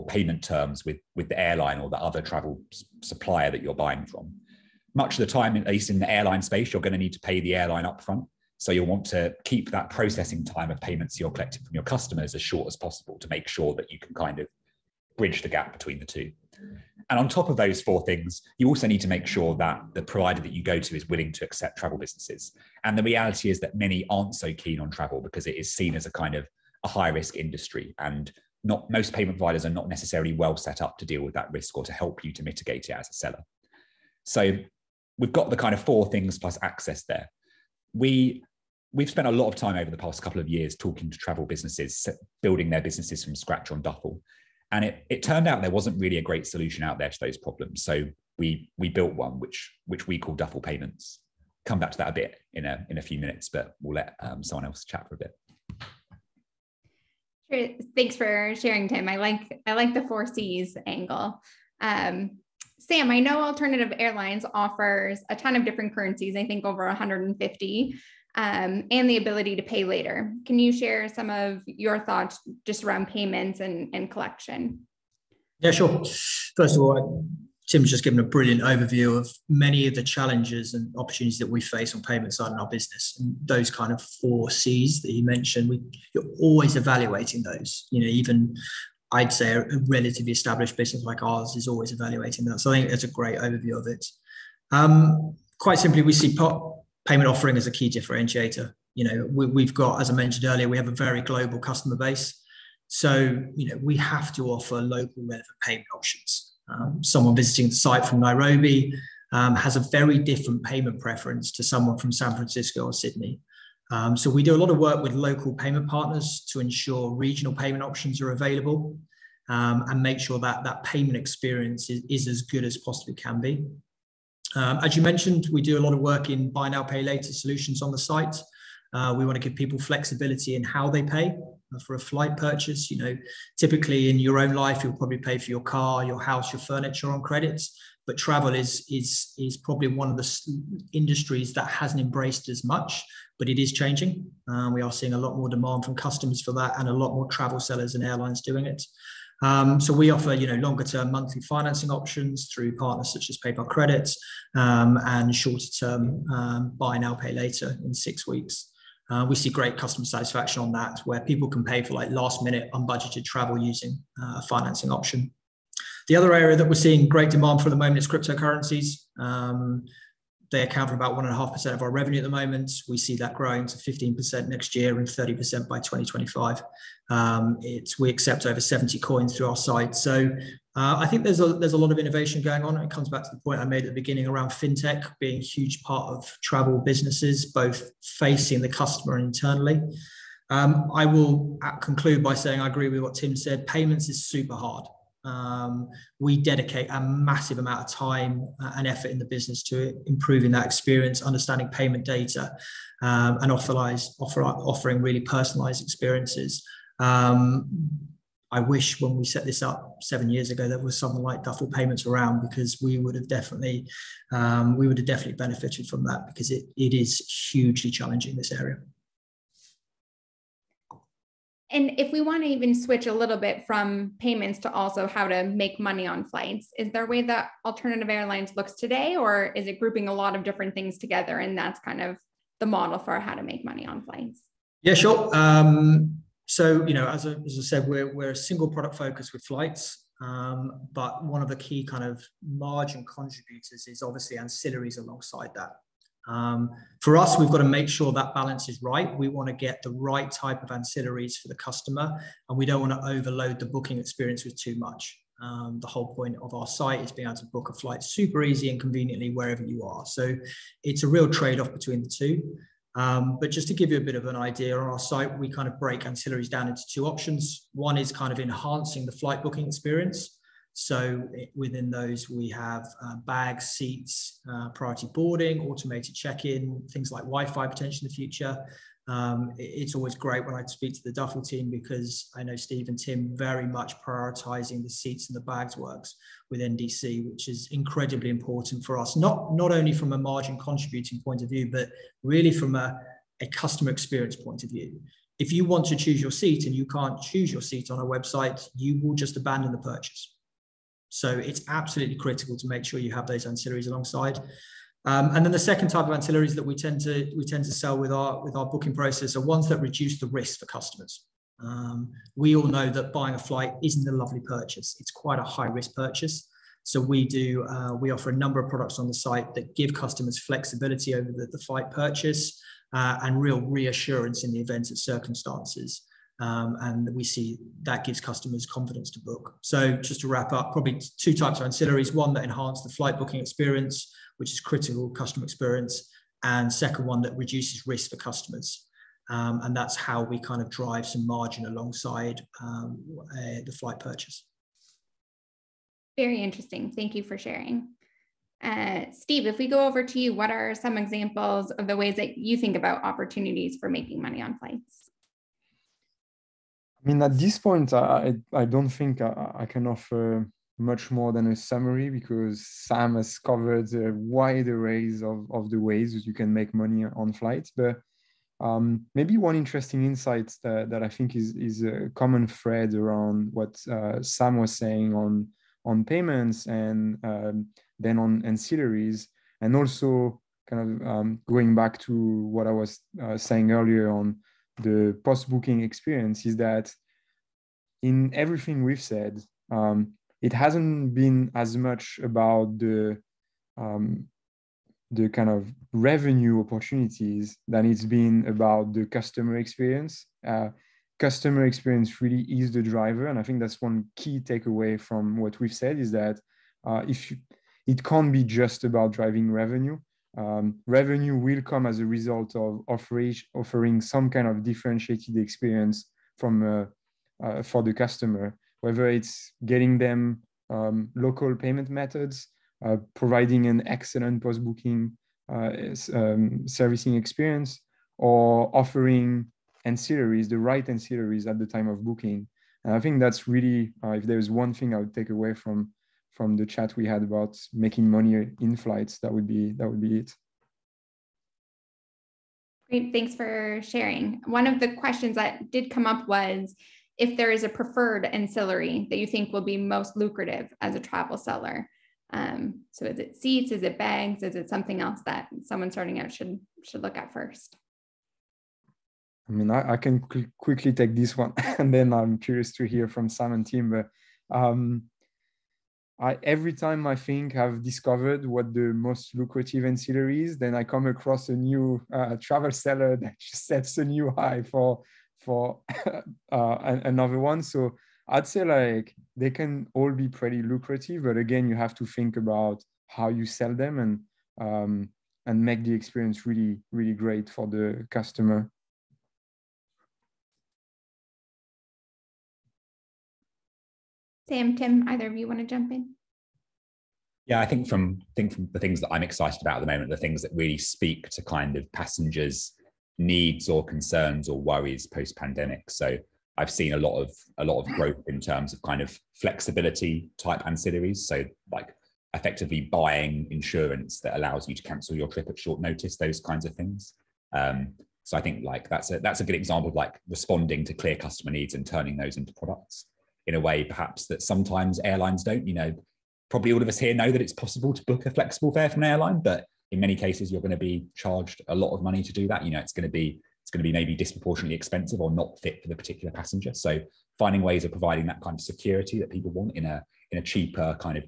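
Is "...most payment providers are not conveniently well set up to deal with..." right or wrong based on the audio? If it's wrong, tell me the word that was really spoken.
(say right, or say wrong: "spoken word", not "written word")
wrong: "necessarily", not "conveniently".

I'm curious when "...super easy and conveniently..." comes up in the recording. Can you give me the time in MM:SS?
04:18.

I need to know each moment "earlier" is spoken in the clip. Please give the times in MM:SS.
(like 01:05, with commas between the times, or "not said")
01:40, 06:23.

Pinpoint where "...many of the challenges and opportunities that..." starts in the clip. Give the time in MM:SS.
01:19.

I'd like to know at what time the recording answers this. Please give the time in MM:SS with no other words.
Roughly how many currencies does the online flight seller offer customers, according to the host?
01:06.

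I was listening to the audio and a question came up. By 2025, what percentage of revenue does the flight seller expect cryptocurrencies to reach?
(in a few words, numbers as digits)
30%.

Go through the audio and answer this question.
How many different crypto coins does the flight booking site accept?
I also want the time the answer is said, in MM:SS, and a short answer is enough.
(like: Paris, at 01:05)
over 70, at 02:58.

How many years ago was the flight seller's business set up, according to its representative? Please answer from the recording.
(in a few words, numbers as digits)
7.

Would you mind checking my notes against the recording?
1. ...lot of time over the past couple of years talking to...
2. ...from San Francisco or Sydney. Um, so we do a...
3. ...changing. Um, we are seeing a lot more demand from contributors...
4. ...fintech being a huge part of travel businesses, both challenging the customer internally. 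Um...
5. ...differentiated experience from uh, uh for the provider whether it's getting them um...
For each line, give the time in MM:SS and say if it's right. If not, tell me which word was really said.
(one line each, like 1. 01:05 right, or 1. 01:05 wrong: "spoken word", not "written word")
1. 00:39 right
2. 01:51 right
3. 02:23 wrong: "customers", not "contributors"
4. 03:04 wrong: "facing", not "challenging"
5. 06:54 wrong: "customer", not "provider".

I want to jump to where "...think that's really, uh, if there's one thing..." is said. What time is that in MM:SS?
07:12.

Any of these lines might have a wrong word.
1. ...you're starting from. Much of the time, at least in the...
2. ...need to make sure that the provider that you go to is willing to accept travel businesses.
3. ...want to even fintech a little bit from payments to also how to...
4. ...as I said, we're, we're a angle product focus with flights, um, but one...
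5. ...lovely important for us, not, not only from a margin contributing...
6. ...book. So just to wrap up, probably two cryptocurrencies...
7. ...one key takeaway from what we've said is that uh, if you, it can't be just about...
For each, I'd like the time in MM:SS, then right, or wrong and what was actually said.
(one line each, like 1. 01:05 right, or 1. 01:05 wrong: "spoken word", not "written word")
1. 00:03 wrong: "buying", not "starting"
2. 00:18 right
3. 03:42 wrong: "switch", not "fintech"
4. 03:57 wrong: "single", not "angle"
5. 04:47 wrong: "incredibly", not "lovely"
6. 05:29 wrong: "types", not "cryptocurrencies"
7. 06:43 right.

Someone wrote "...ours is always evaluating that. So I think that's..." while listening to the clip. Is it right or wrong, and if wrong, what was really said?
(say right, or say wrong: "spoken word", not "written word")
right.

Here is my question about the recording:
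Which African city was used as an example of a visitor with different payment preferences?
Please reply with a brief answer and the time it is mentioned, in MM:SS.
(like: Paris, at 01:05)
Nairobi, at 01:48.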